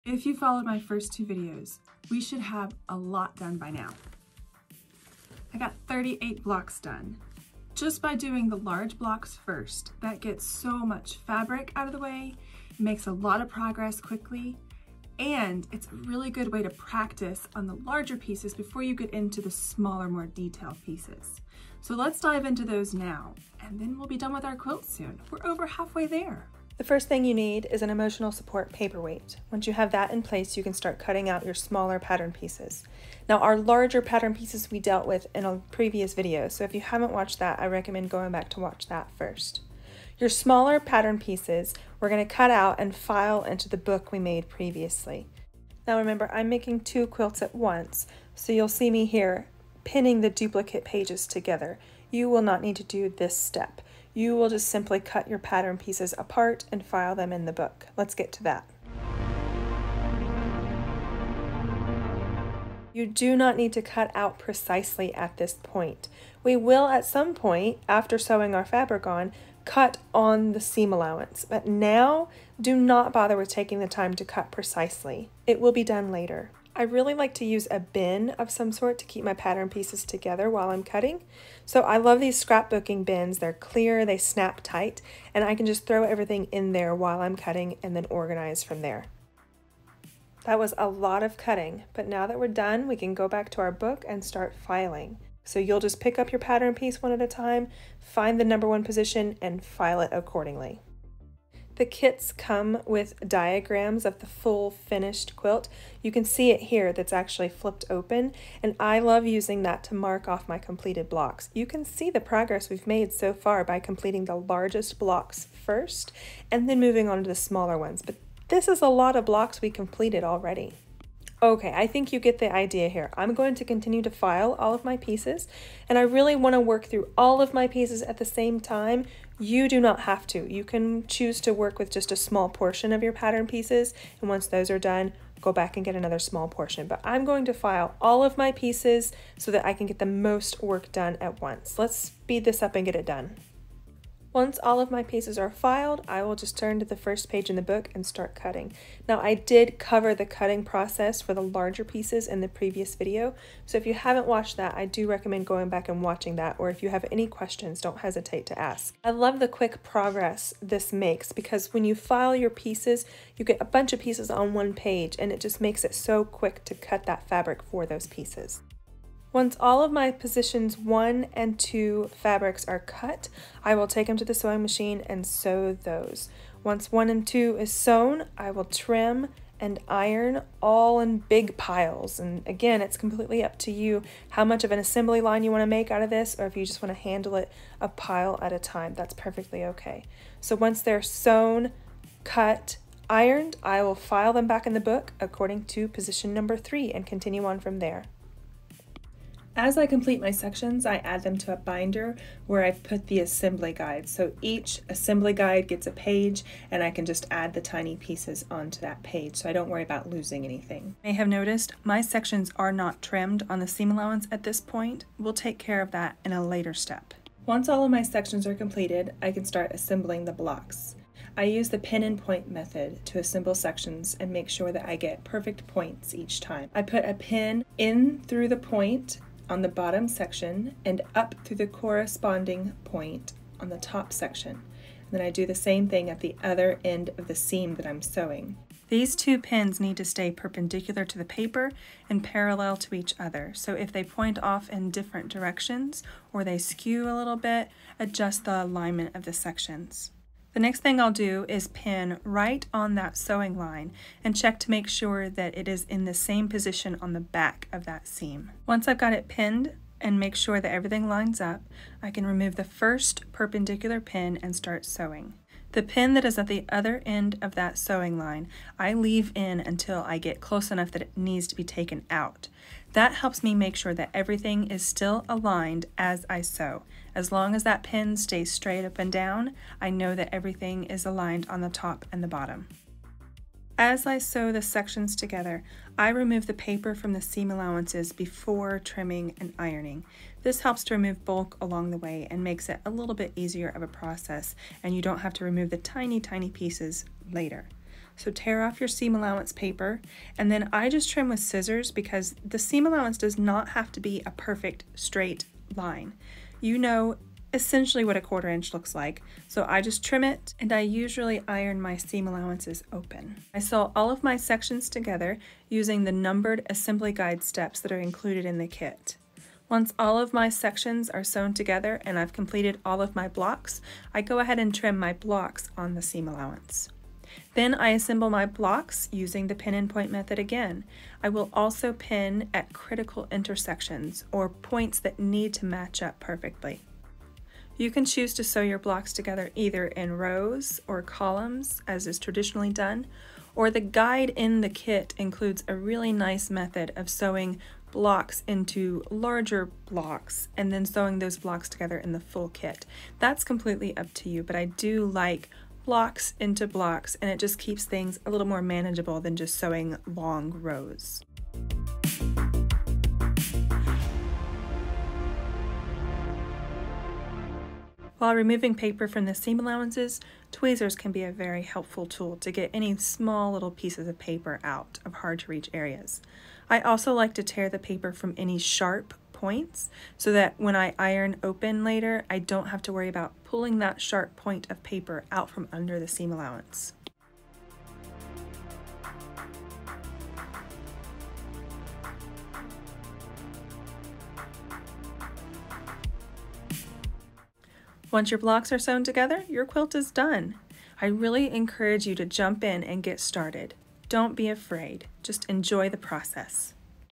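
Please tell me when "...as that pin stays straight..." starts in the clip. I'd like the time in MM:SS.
04:37.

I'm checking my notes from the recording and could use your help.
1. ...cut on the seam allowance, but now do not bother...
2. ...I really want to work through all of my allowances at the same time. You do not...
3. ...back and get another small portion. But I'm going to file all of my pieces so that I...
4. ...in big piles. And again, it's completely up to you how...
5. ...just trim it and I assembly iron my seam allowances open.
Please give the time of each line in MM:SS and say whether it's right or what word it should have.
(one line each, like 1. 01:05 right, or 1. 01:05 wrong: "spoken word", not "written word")
1. 01:09 right
2. 02:05 wrong: "pieces", not "allowances"
3. 02:15 right
4. 03:00 right
5. 05:09 wrong: "usually", not "assembly".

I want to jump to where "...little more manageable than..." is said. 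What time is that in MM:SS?
05:58.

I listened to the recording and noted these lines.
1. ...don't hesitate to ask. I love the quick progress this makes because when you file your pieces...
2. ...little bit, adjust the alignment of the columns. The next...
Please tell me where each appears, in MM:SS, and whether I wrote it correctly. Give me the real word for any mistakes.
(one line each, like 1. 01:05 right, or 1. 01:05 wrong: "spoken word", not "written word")
1. 02:37 right
2. 04:07 wrong: "sections", not "columns".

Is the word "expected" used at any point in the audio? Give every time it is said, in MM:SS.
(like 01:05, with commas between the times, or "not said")
not said.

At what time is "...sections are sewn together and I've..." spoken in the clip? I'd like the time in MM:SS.
05:20.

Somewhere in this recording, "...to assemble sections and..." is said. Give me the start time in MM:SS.
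03:43.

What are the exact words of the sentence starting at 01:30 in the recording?
That was a lot of cutting, but now that we're done, we can go back to our book and start filing.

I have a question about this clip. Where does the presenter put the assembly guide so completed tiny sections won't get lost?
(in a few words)
A binder.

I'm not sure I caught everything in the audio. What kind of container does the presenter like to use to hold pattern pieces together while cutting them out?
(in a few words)
Scrapbooking bins.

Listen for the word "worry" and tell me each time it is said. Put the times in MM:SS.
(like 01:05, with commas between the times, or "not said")
03:29, 06:22.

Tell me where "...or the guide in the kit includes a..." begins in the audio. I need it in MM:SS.
05:43.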